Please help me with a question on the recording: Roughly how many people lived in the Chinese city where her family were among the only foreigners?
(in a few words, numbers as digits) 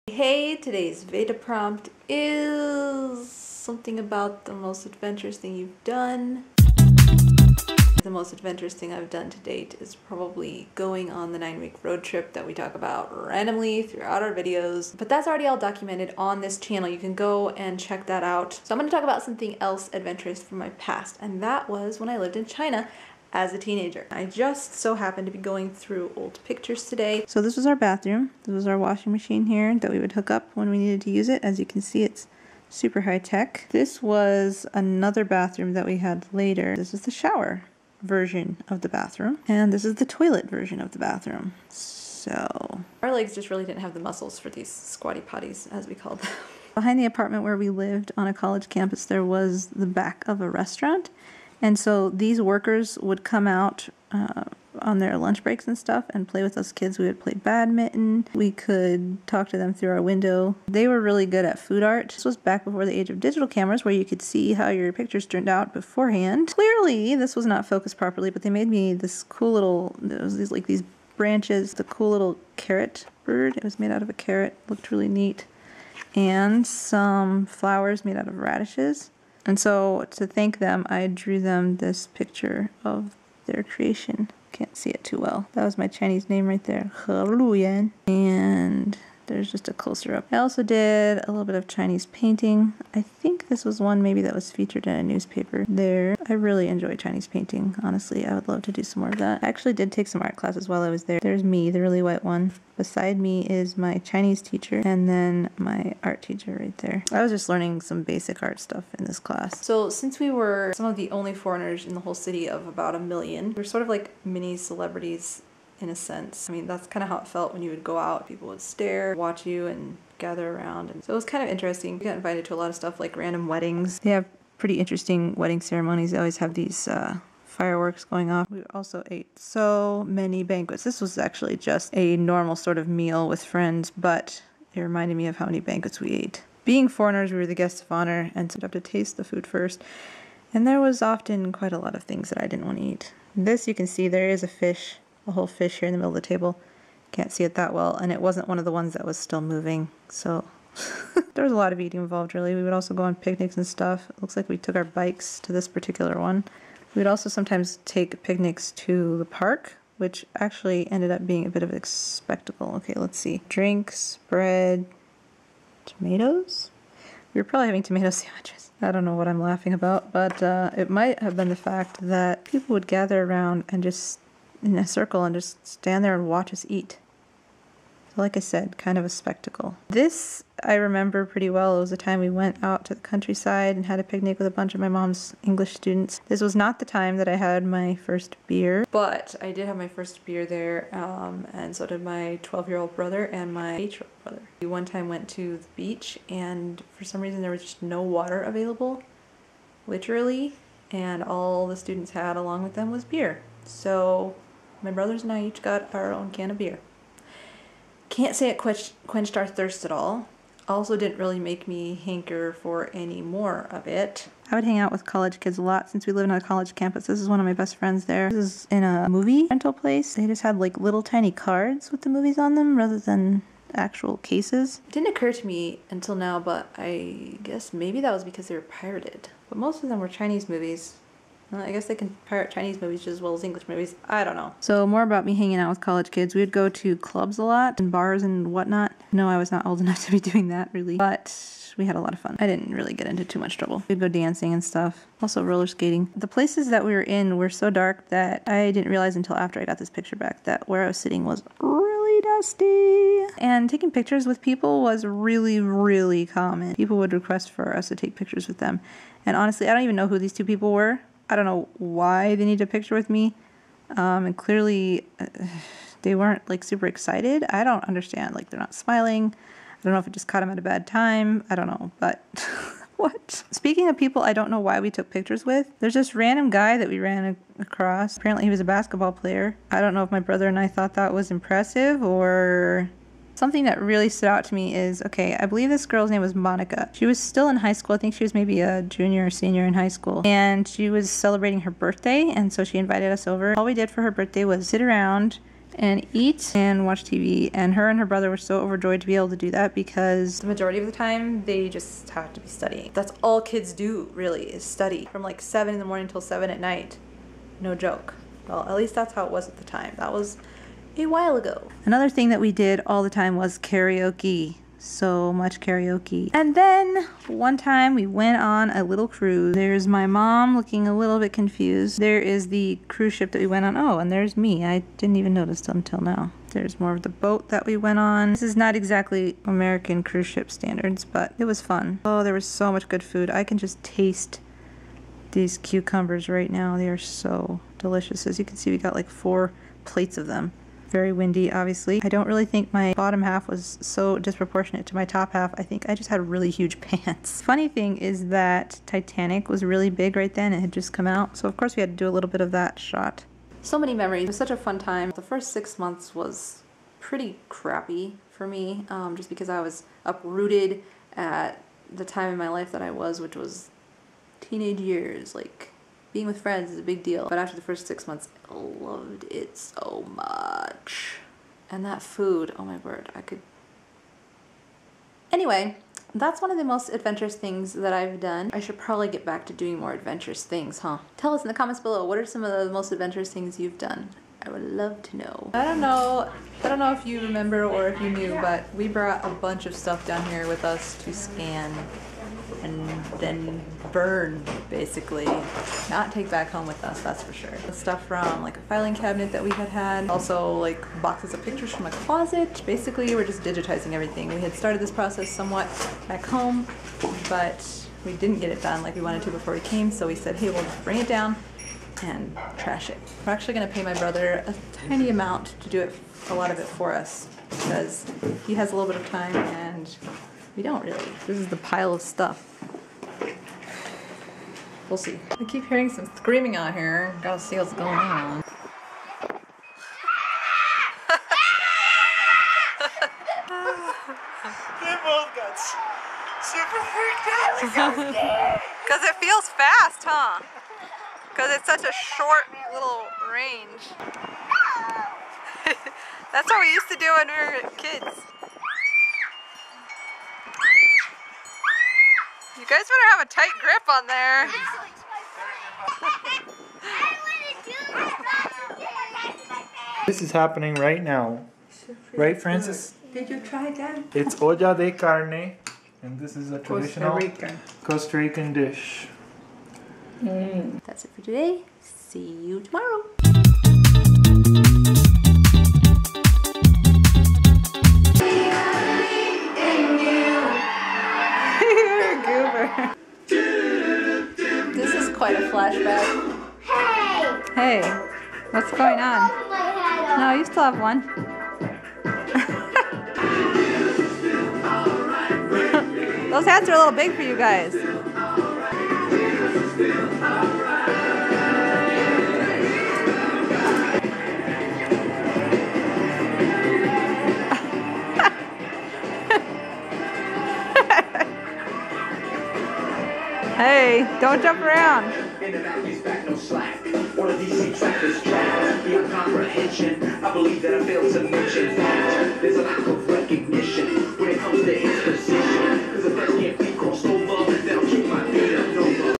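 About a million.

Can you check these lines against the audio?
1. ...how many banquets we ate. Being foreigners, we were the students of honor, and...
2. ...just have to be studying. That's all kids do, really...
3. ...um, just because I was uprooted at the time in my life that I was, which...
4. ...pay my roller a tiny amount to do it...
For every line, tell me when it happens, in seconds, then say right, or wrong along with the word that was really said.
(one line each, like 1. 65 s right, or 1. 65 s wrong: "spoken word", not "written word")
1. 135 s wrong: "guests", not "students"
2. 301 s right
3. 358 s right
4. 413 s wrong: "brother", not "roller".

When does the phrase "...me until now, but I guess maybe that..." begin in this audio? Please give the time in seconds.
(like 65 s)
225 s.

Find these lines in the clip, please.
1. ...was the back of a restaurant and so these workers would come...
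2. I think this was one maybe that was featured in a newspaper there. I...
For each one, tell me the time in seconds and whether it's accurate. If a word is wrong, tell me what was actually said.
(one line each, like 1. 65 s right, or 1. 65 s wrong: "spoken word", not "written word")
1. 49 s right
2. 92 s right.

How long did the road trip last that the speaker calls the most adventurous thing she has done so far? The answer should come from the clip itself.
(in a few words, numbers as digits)
9 weeks.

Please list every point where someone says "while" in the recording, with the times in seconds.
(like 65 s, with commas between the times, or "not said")
100 s, 311 s.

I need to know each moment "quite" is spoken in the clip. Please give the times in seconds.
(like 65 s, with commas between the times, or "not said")
141 s, 485 s.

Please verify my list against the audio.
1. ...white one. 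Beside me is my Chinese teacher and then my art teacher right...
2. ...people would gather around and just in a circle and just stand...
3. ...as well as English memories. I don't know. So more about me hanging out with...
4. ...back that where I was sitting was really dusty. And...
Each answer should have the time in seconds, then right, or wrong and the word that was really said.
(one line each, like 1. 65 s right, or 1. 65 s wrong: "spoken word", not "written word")
1. 102 s right
2. 172 s right
3. 233 s wrong: "movies", not "memories"
4. 250 s right.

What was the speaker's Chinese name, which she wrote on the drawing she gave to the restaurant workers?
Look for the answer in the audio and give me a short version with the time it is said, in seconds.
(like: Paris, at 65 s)
He Luyan, at 87 s.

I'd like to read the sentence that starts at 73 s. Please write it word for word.
It was made out of a carrot, looked really neat.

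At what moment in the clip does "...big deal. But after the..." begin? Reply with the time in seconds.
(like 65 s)
366 s.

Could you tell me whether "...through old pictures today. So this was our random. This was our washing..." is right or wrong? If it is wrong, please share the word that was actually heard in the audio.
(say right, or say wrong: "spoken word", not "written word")
wrong: "bathroom", not "random".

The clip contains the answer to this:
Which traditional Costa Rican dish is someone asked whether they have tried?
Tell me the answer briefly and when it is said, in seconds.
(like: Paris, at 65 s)
Olla de carne, at 464 s.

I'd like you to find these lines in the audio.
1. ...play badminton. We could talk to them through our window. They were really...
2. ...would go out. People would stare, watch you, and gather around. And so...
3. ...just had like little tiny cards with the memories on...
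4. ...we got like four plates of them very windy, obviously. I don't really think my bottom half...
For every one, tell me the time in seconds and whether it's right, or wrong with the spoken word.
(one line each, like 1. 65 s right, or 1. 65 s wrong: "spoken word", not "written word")
1. 57 s right
2. 117 s right
3. 220 s wrong: "movies", not "memories"
4. 338 s right.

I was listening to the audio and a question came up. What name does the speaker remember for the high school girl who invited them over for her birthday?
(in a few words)
Monica.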